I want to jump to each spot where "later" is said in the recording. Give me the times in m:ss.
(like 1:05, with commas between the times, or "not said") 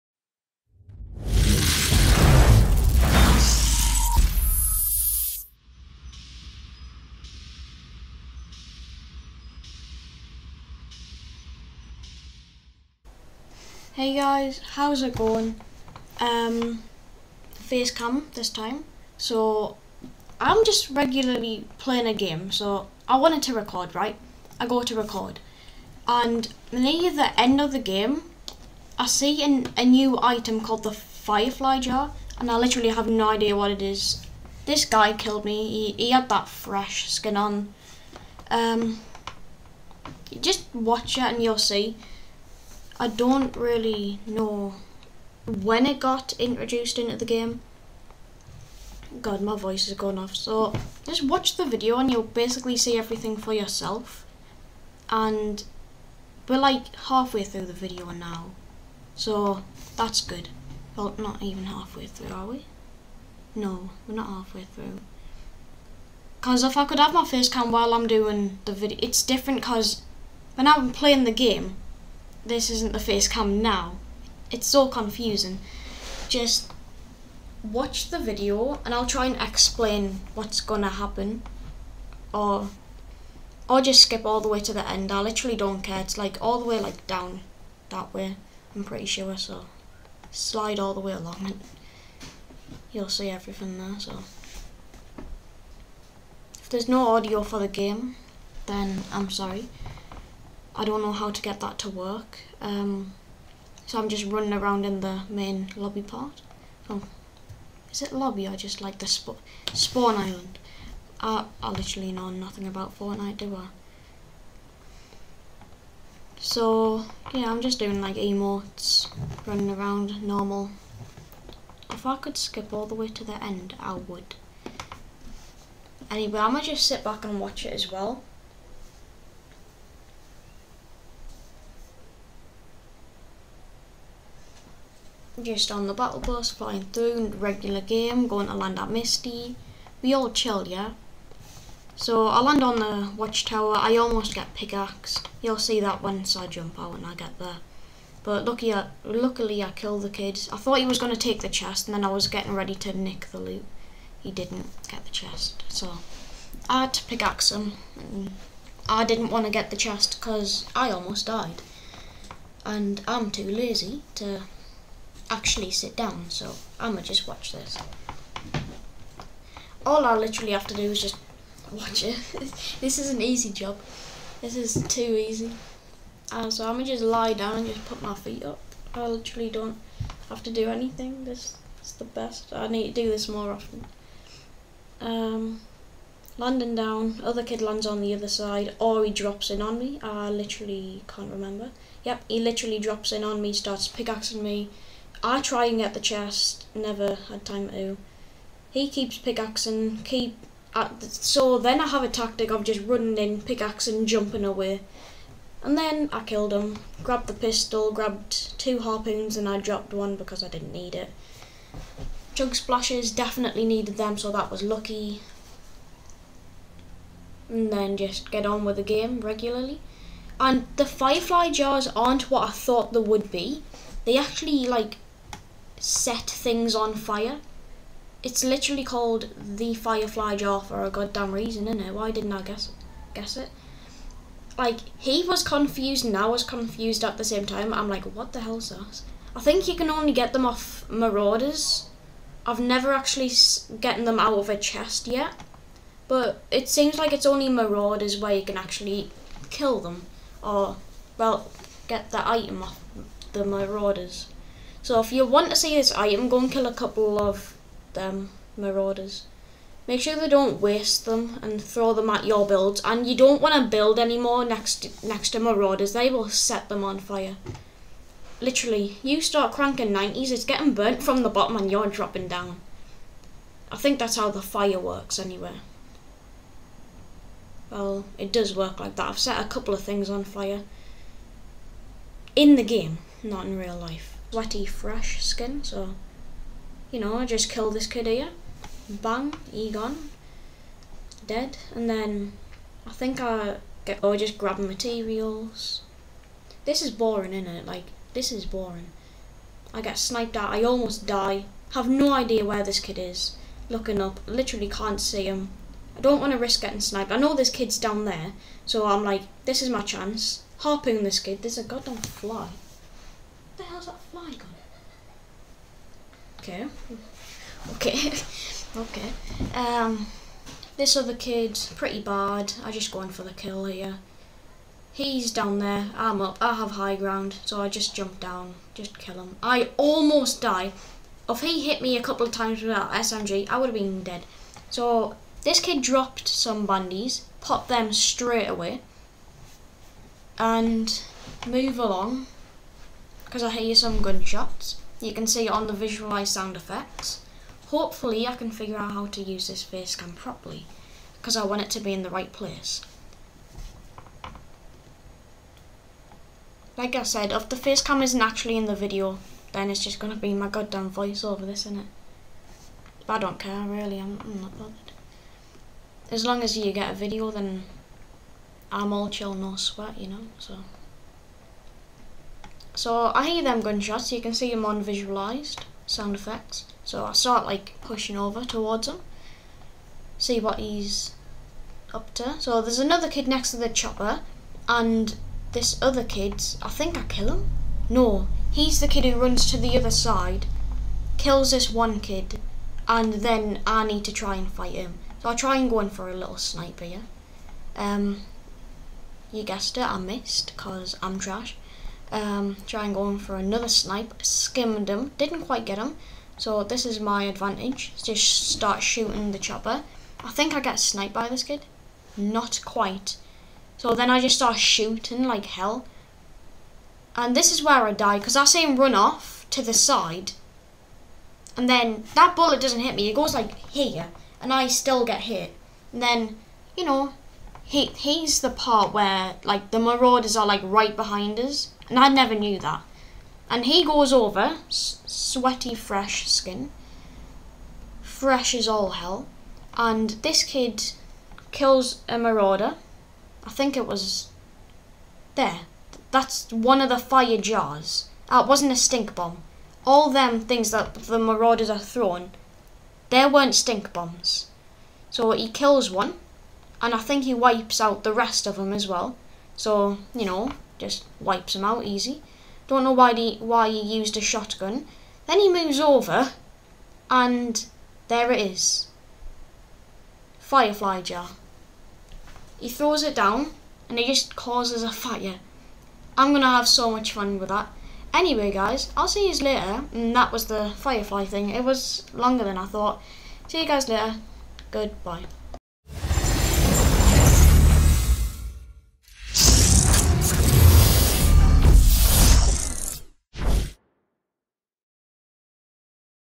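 7:59, 8:03.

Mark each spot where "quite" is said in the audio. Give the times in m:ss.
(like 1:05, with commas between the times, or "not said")
6:45, 6:52.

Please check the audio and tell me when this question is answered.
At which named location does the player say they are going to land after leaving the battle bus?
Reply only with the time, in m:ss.
2:18.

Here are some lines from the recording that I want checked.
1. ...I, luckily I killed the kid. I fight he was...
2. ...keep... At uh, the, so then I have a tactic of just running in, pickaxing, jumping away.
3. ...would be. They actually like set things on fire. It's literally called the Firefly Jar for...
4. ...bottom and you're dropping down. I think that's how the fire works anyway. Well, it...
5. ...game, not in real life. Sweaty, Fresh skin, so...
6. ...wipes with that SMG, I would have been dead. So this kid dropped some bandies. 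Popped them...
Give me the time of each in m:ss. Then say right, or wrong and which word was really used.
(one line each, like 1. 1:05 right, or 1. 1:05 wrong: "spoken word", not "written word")
1. 2:28 wrong: "thought", not "fight"
2. 3:20 right
3. 3:42 right
4. 4:31 right
5. 4:42 right
6. 5:32 wrong: "times", not "wipes".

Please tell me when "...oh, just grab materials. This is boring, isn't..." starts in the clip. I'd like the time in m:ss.
4:54.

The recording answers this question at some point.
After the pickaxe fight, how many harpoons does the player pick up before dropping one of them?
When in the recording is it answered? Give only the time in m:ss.
3:28.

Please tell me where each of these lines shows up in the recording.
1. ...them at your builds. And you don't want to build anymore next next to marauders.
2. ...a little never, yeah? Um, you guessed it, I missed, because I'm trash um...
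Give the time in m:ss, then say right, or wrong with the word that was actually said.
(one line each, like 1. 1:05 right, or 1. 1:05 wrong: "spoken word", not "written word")
1. 4:21 right
2. 6:36 wrong: "sniper", not "never".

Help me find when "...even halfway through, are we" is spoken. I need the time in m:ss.
1:01.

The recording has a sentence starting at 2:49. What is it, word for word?
All I literally have to do is just watch it.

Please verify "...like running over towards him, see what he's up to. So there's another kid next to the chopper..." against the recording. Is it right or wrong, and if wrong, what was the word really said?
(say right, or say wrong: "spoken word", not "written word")
wrong: "pushing", not "running".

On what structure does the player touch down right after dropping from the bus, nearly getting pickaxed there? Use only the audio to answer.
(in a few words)
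watchtower.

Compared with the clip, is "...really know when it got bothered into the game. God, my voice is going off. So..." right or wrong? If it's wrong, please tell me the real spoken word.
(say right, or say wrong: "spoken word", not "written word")
wrong: "introduced", not "bothered".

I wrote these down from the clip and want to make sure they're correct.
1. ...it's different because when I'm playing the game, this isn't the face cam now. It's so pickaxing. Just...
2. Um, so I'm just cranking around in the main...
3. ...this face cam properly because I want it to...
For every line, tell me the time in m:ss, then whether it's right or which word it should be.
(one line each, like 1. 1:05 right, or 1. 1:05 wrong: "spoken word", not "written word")
1. 1:09 wrong: "confusing", not "pickaxing"
2. 1:42 wrong: "running", not "cranking"
3. 5:49 right.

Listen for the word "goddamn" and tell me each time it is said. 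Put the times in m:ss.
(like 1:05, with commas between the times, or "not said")
3:50, 5:11, 6:00.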